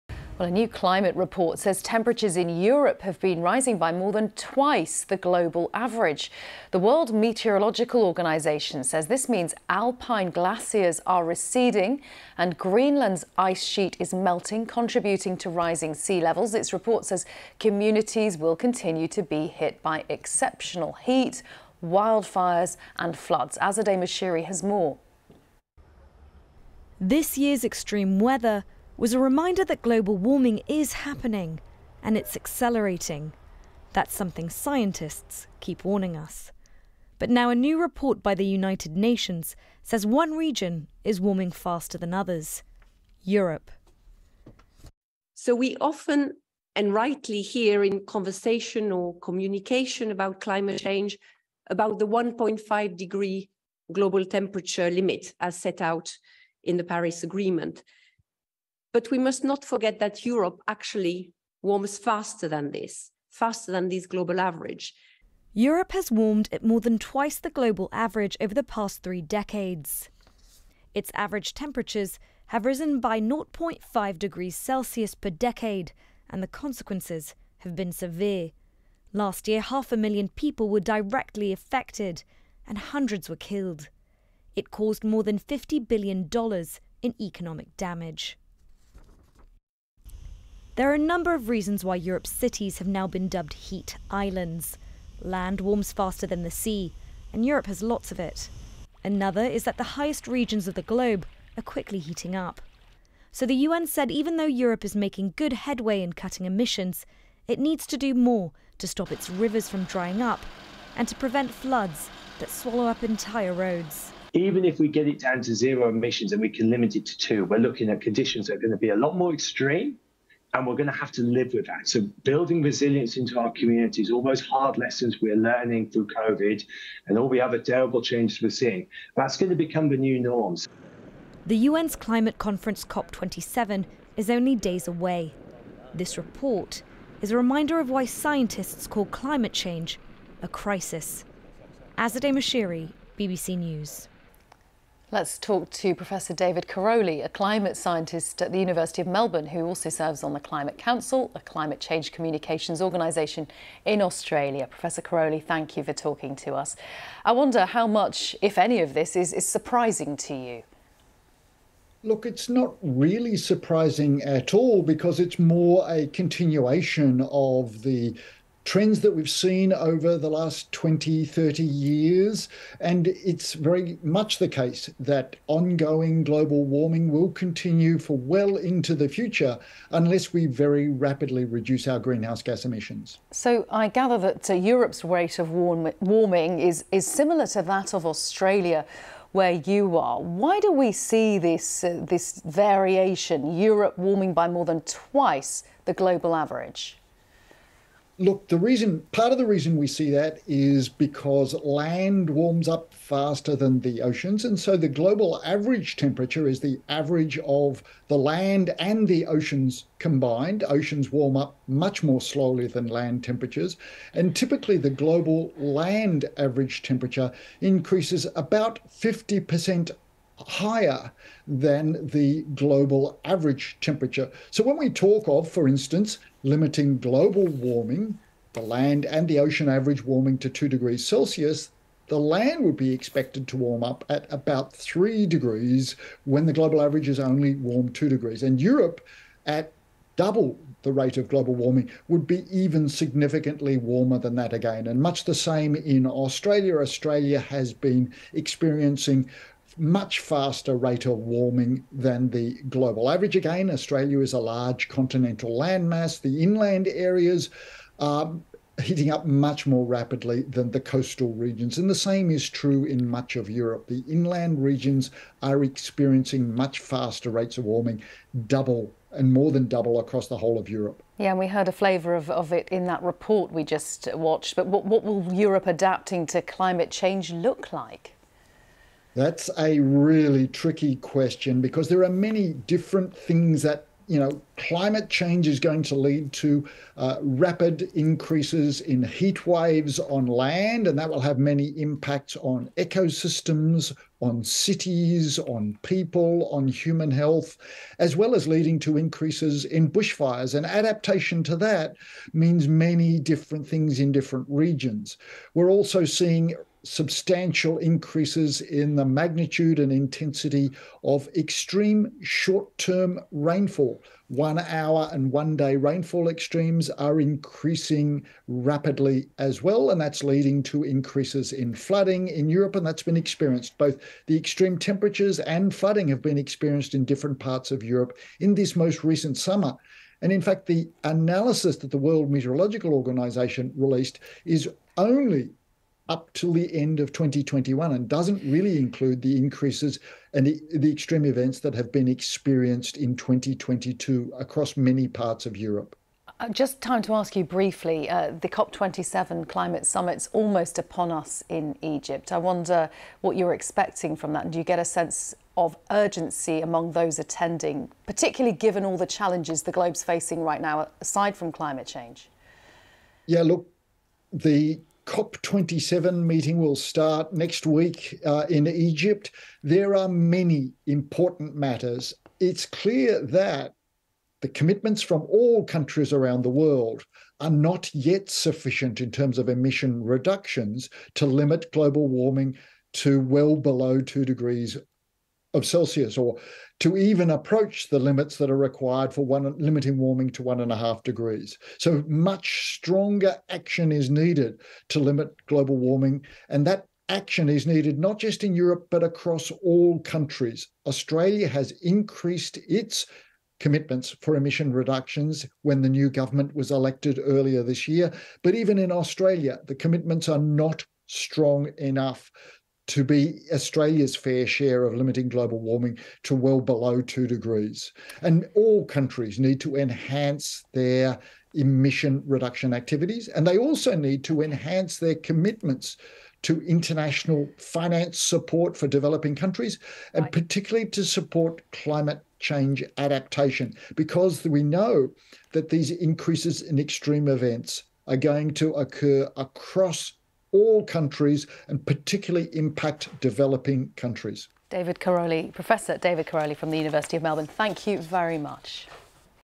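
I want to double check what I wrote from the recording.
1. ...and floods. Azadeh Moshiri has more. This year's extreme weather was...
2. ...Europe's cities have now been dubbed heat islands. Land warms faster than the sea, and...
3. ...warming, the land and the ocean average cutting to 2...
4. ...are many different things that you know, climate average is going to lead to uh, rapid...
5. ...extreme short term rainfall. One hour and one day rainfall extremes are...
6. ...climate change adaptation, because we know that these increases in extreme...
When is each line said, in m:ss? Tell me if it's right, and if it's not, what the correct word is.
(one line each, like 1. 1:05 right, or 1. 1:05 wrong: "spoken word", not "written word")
1. 0:22 right
2. 1:31 right
3. 3:47 wrong: "warming", not "cutting"
4. 4:42 wrong: "change", not "average"
5. 5:11 right
6. 7:11 right.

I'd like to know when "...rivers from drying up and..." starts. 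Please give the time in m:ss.
1:49.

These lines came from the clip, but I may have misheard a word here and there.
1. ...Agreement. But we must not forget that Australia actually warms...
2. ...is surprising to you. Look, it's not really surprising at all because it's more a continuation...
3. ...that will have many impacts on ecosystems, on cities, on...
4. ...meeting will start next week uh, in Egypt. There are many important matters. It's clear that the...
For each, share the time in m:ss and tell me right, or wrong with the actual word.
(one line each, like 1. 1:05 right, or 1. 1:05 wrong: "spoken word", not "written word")
1. 0:57 wrong: "Europe", not "Australia"
2. 2:39 right
3. 4:50 right
4. 6:06 right.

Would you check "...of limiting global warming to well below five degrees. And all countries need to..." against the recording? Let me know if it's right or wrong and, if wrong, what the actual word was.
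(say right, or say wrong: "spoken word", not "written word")
wrong: "two", not "five".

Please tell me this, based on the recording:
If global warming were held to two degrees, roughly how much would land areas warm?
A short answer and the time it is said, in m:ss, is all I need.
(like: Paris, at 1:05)
3 degrees, at 3:54.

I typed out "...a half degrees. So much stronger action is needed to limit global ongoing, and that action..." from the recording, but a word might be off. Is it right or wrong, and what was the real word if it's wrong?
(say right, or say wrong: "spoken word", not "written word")
wrong: "warming", not "ongoing".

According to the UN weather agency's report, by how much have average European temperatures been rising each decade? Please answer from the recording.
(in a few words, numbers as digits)
0.5 degrees Celsius.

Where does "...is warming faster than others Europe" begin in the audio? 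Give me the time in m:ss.
0:41.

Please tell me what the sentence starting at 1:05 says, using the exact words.
Europe has warmed at more than twice the global average over the past three decades.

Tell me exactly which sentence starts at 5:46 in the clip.
Uh, just time to ask you briefly uh, the COP27 climate summit's almost upon us in Egypt.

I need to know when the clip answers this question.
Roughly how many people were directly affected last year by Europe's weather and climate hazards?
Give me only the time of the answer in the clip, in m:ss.
1:19.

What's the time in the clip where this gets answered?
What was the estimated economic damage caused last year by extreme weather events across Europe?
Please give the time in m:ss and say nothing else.
1:25.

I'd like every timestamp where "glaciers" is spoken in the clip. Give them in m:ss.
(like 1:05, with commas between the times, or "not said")
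0:10.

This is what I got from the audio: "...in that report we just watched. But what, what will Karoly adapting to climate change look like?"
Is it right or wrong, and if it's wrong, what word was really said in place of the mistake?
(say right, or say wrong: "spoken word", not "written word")
wrong: "Europe", not "Karoly".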